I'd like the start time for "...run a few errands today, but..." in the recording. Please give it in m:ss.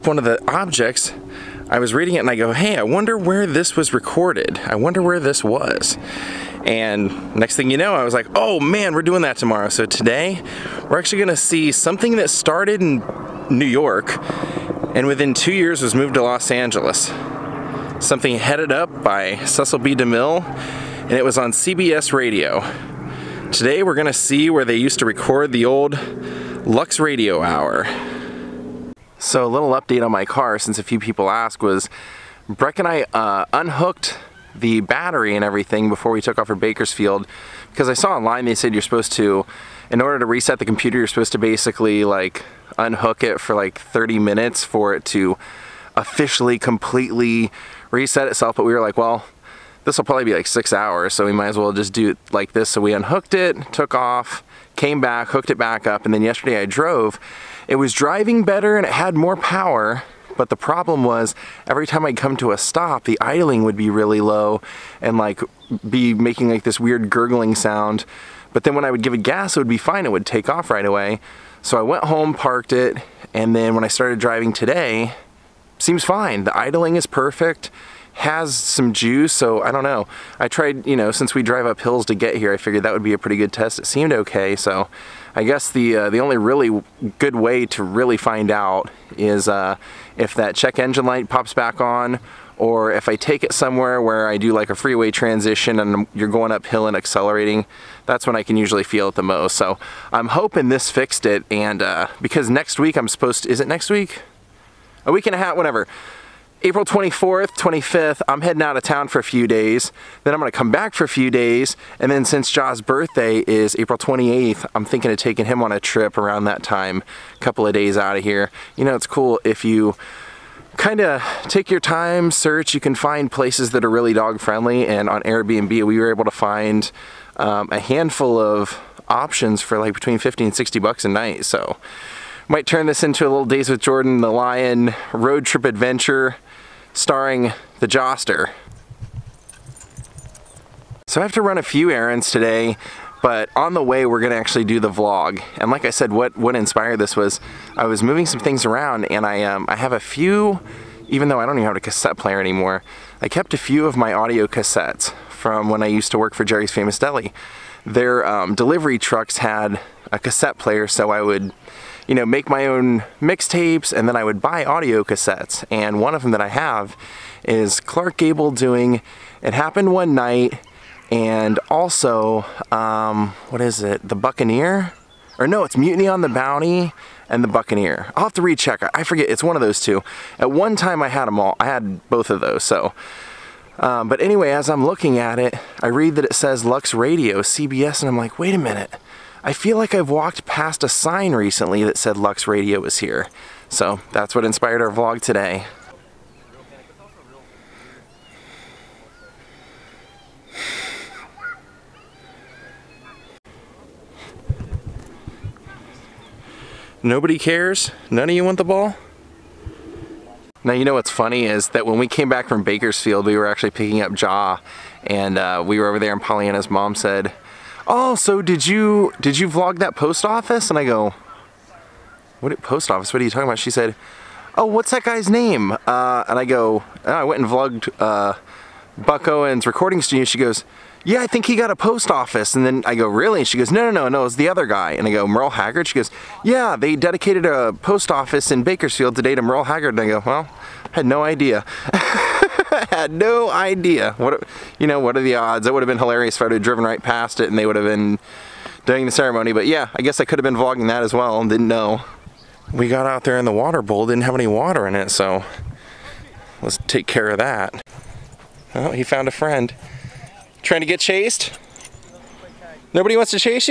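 2:21.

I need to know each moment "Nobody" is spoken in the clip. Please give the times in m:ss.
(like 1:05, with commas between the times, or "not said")
3:27, 4:22.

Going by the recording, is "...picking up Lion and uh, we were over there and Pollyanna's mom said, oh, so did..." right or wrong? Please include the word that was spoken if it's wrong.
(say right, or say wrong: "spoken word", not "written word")
wrong: "Jaw", not "Lion".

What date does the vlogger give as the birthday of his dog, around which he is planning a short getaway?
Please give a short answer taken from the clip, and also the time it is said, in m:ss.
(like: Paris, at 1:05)
April 28th, at 1:53.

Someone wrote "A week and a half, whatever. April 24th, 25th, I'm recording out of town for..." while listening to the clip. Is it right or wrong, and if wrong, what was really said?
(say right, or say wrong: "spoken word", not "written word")
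wrong: "heading", not "recording".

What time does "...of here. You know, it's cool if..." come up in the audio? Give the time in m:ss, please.
1:58.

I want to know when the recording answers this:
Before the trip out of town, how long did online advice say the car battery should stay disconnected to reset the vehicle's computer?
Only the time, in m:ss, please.
0:43.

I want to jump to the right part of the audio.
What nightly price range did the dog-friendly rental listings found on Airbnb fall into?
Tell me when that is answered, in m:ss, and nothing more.
2:09.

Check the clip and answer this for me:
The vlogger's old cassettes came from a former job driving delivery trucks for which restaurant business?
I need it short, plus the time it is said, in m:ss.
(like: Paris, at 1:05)
Jerry's Famous Deli, at 2:36.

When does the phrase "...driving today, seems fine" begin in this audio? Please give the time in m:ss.
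1:14.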